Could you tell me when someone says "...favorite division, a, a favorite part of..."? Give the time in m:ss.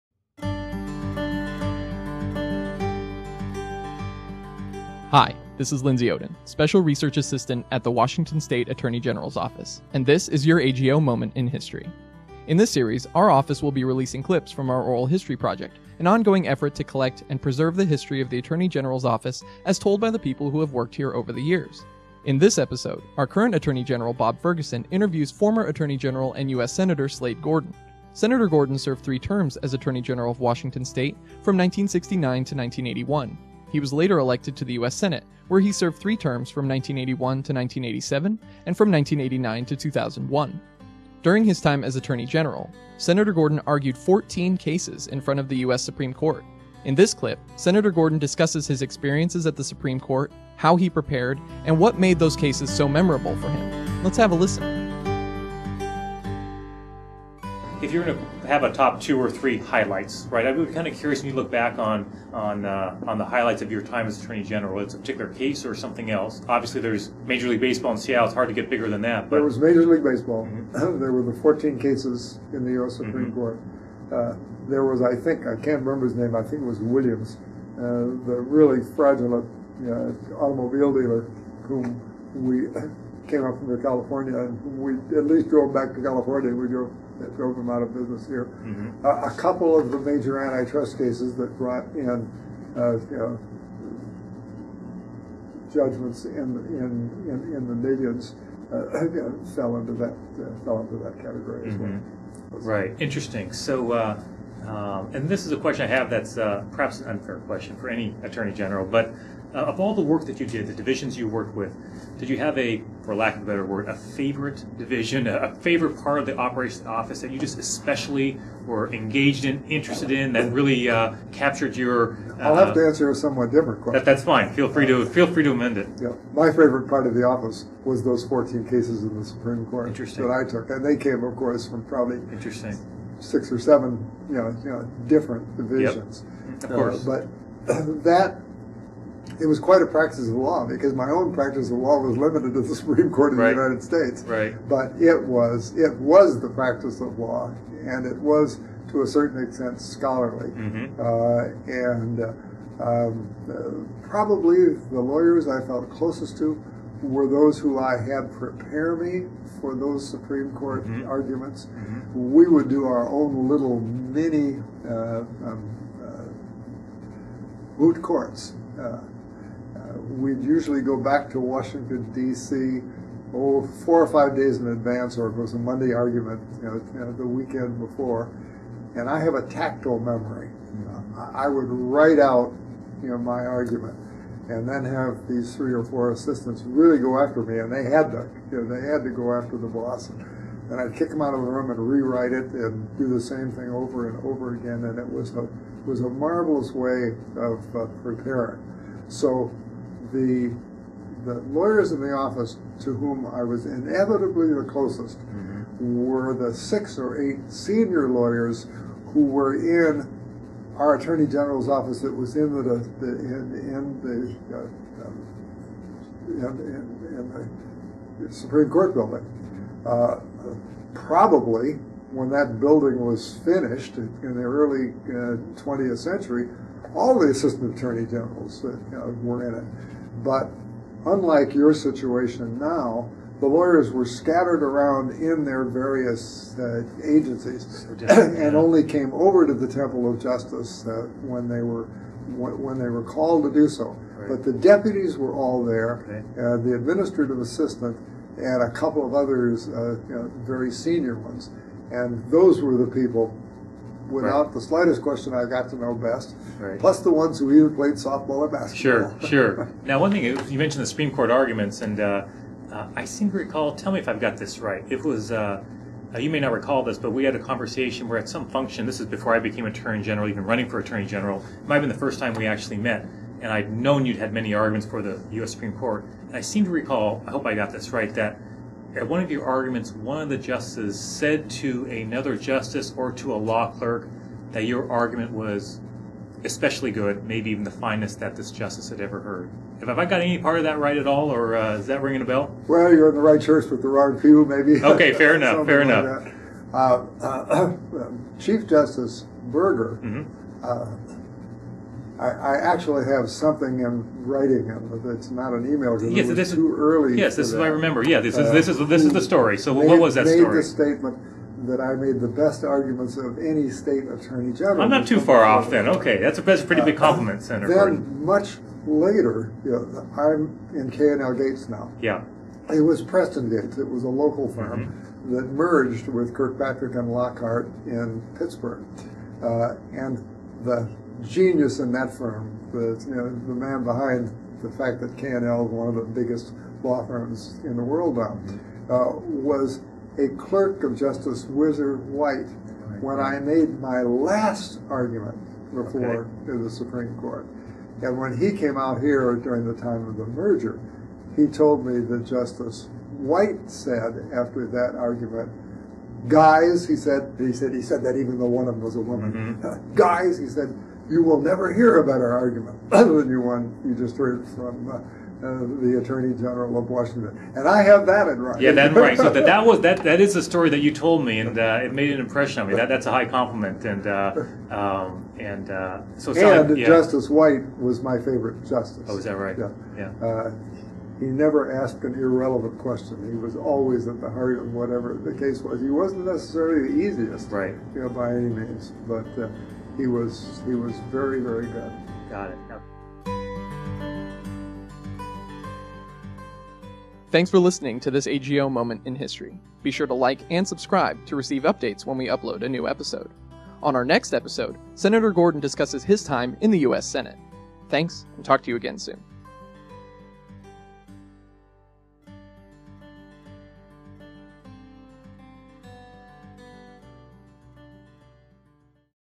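1:53.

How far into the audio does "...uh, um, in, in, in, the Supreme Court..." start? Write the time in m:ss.
3:34.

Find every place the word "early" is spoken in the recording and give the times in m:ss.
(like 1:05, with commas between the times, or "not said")
3:44, 5:06.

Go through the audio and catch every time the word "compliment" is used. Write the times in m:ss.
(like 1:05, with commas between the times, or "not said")
5:16, 6:13.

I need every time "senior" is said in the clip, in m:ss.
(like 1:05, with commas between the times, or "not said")
3:27, 4:10.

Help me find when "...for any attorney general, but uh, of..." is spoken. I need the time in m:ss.
1:47.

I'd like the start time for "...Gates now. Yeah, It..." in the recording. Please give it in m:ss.
5:21.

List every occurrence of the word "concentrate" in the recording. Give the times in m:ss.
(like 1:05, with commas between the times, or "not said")
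not said.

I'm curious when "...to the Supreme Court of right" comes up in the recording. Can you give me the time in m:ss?
2:22.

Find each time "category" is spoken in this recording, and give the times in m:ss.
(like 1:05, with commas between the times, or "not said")
1:41.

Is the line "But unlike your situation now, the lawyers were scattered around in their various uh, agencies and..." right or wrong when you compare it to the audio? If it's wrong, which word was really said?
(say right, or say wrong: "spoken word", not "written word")
right.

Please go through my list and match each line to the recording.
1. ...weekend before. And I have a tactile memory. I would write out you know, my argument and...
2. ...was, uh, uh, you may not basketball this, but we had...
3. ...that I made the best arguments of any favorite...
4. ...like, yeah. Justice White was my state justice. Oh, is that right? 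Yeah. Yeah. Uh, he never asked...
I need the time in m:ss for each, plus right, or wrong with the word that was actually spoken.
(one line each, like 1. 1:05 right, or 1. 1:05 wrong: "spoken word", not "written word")
1. 2:57 right
2. 4:25 wrong: "recall", not "basketball"
3. 5:11 wrong: "state", not "favorite"
4. 6:16 wrong: "favorite", not "state".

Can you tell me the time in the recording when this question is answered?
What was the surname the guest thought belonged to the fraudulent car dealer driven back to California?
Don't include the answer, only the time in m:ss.
1:16.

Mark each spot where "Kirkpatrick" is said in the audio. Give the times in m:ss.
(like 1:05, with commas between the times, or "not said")
5:26.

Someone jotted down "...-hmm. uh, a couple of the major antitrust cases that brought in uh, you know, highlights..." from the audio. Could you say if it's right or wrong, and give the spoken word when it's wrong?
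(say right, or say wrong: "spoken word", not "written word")
wrong: "judgments", not "highlights".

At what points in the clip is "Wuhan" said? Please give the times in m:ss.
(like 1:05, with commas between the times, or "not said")
not said.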